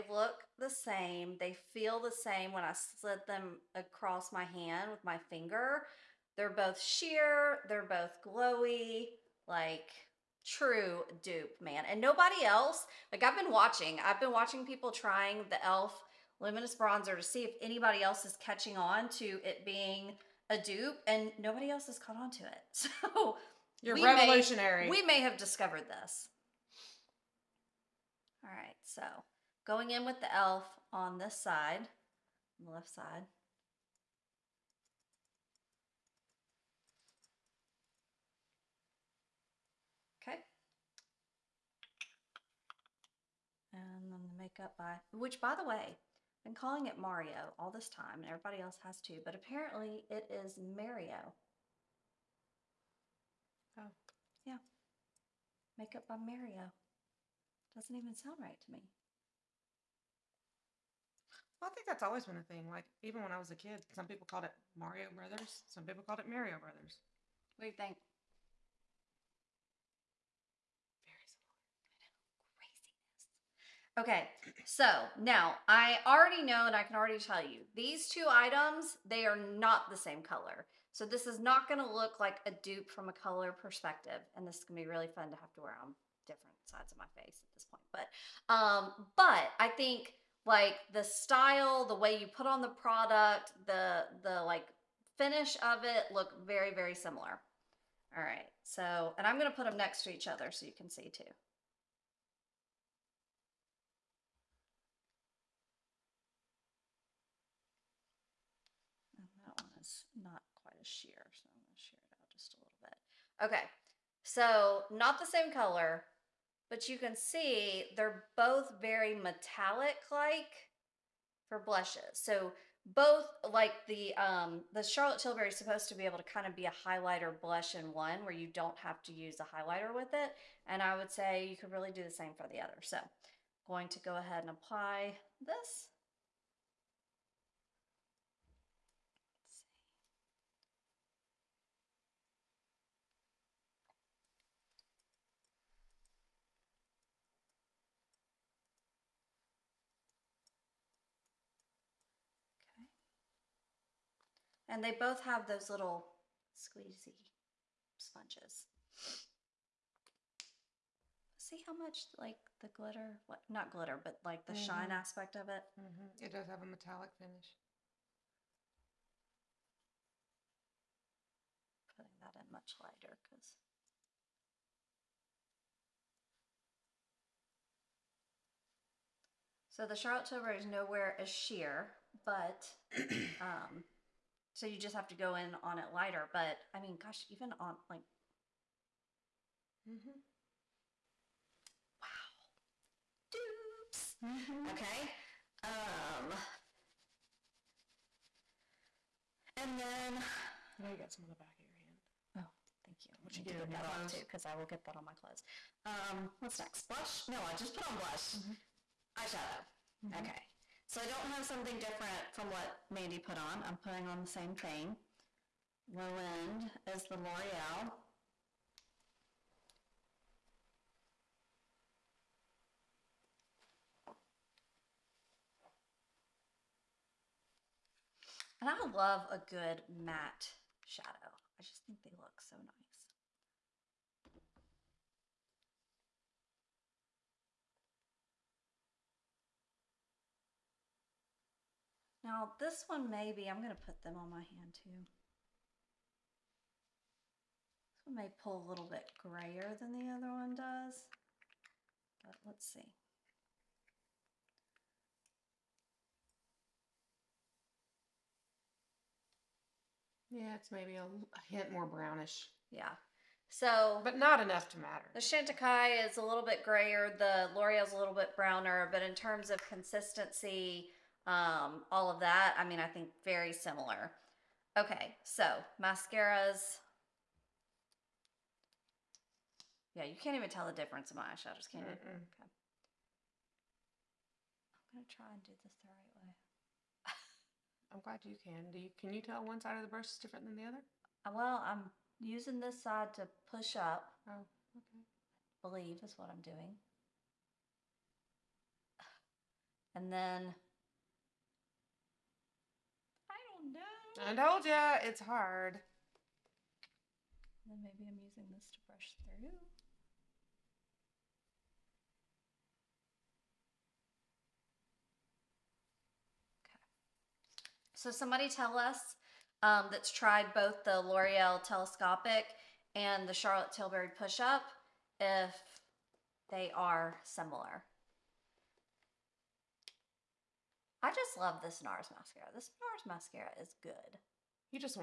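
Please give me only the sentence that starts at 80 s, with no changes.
So this is not gonna look like a dupe from a color perspective.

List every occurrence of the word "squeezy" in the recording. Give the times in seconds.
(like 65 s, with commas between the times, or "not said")
156 s.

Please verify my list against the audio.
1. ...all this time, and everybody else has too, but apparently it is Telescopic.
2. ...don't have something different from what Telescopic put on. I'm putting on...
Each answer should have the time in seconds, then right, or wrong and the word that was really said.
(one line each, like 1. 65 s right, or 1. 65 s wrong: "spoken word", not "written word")
1. 47 s wrong: "Mario", not "Telescopic"
2. 211 s wrong: "Mandy", not "Telescopic".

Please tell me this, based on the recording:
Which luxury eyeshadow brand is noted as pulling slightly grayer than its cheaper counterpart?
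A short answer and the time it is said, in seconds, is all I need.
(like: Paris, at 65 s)
Chantecaille, at 265 s.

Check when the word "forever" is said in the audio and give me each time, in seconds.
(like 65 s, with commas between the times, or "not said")
not said.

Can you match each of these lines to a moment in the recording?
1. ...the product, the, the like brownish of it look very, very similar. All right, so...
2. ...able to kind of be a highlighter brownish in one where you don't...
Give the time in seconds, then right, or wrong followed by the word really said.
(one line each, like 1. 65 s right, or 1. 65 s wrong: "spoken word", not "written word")
1. 92 s wrong: "finish", not "brownish"
2. 126 s wrong: "blush", not "brownish".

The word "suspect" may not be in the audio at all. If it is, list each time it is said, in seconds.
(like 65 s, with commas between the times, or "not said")
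not said.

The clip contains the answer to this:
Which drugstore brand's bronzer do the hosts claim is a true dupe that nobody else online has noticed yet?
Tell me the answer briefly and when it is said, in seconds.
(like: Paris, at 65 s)
e.l.f. Luminous Bronzer, at 15 s.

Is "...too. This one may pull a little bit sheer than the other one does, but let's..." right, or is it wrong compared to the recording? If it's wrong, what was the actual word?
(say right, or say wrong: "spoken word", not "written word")
wrong: "grayer", not "sheer".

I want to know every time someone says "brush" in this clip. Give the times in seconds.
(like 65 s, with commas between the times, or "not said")
289 s, 308 s.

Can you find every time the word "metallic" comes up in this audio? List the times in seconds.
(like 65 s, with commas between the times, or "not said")
119 s, 166 s.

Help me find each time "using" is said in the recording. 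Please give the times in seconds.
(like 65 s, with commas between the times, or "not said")
292 s, 308 s.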